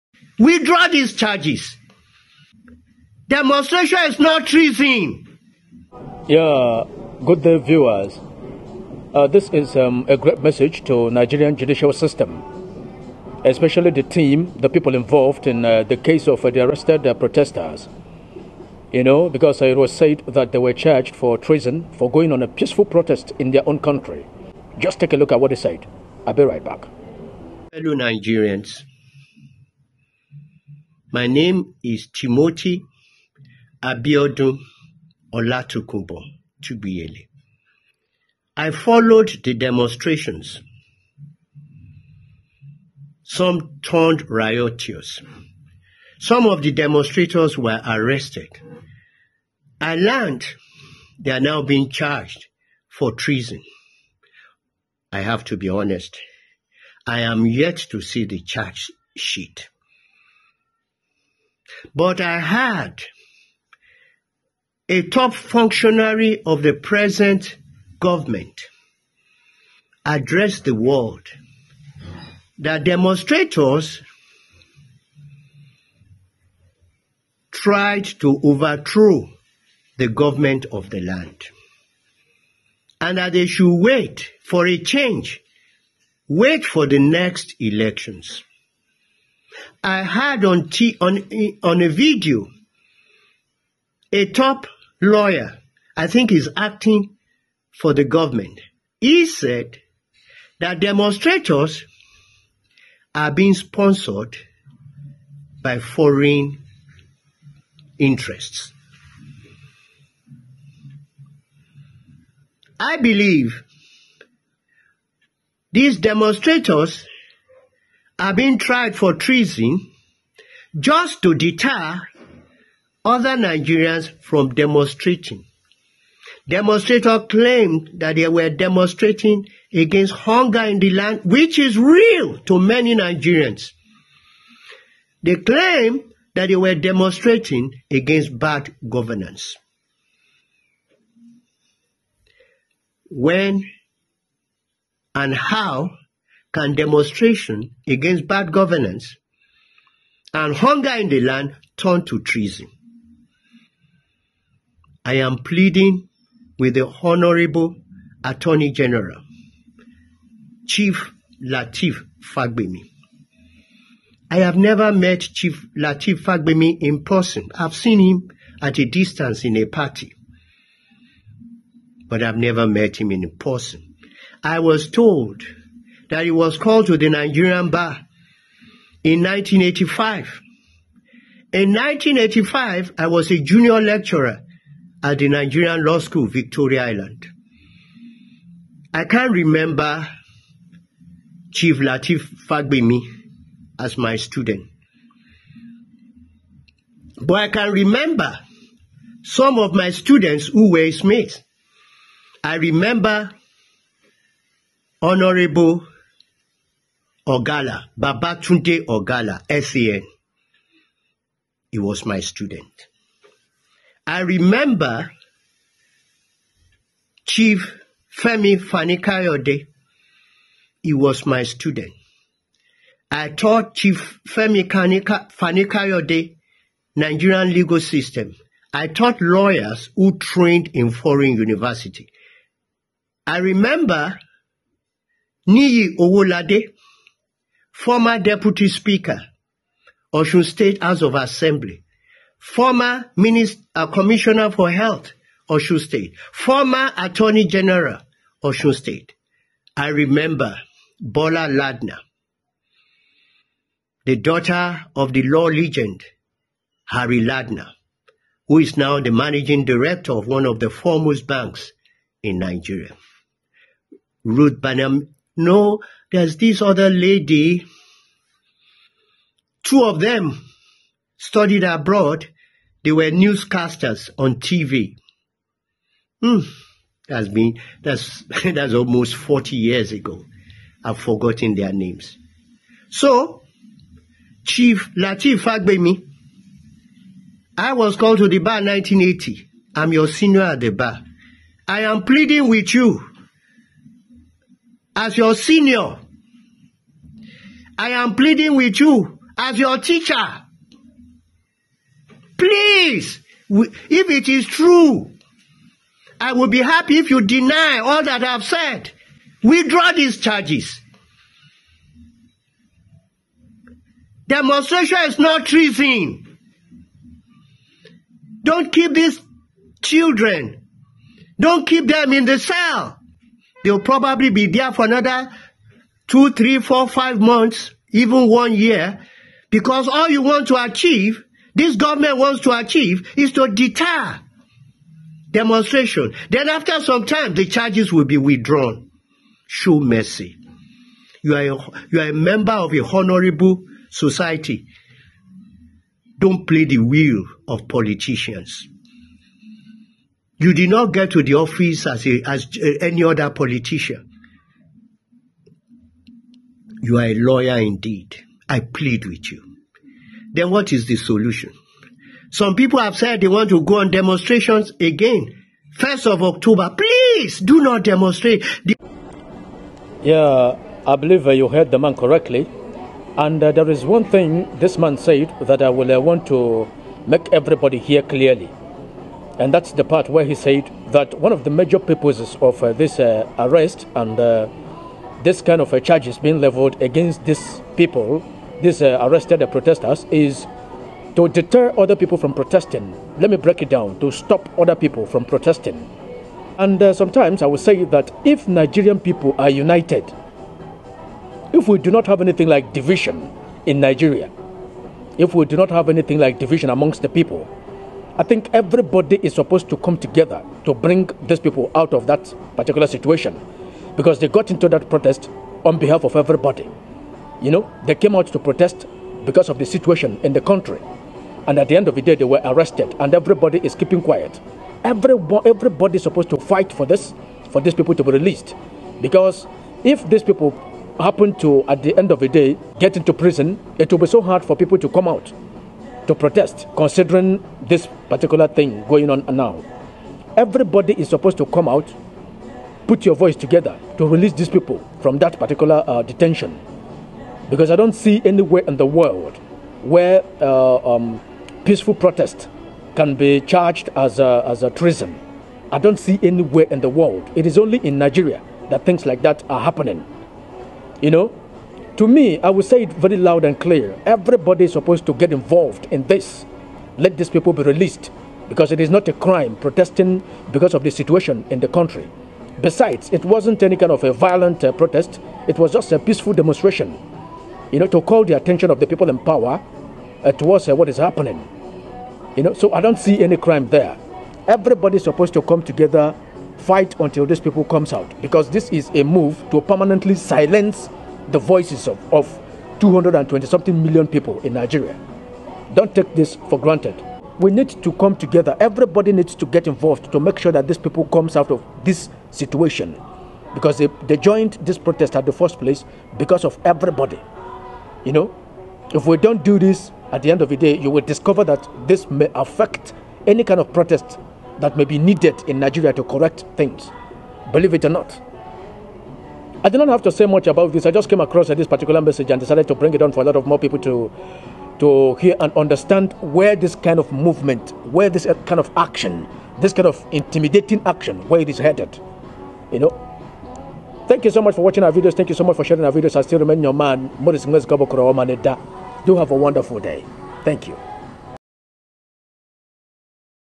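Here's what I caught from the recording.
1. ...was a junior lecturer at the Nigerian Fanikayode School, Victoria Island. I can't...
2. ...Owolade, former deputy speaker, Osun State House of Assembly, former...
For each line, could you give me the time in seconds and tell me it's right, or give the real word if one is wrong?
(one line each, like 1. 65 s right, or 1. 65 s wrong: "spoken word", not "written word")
1. 183 s wrong: "Law", not "Fanikayode"
2. 235 s right.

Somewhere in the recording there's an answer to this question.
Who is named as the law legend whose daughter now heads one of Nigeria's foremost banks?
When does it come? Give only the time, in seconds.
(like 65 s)
256 s.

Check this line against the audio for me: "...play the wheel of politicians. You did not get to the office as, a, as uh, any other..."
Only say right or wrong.
right.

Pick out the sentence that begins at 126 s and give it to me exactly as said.
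Demonstrators claimed that they were demonstrating against hunger in the land, which is real to many Nigerians.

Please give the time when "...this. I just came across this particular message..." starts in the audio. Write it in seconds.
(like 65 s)
520 s.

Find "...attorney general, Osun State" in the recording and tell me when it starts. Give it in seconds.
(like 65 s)
246 s.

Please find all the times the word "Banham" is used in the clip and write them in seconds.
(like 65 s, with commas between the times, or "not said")
264 s.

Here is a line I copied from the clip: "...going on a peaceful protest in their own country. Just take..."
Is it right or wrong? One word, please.
right.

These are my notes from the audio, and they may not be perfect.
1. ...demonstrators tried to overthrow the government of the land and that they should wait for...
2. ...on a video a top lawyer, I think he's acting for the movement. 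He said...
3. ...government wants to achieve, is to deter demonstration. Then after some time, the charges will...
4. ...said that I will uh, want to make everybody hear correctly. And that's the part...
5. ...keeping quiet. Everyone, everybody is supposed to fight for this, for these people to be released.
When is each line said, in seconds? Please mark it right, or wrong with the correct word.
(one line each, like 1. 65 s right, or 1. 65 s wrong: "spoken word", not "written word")
1. 72 s right
2. 91 s wrong: "government", not "movement"
3. 331 s right
4. 374 s wrong: "clearly", not "correctly"
5. 423 s right.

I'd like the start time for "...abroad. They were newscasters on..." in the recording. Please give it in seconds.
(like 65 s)
271 s.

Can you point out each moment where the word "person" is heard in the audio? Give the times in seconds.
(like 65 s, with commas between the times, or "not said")
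167 s, 173 s.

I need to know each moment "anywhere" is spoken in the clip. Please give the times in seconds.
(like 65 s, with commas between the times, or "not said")
448 s, 456 s.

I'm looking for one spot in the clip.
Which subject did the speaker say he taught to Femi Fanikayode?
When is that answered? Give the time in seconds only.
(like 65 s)
226 s.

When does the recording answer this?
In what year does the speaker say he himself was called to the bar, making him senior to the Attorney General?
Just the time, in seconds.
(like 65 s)
288 s.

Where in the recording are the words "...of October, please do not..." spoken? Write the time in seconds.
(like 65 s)
366 s.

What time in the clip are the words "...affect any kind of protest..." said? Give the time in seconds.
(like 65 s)
512 s.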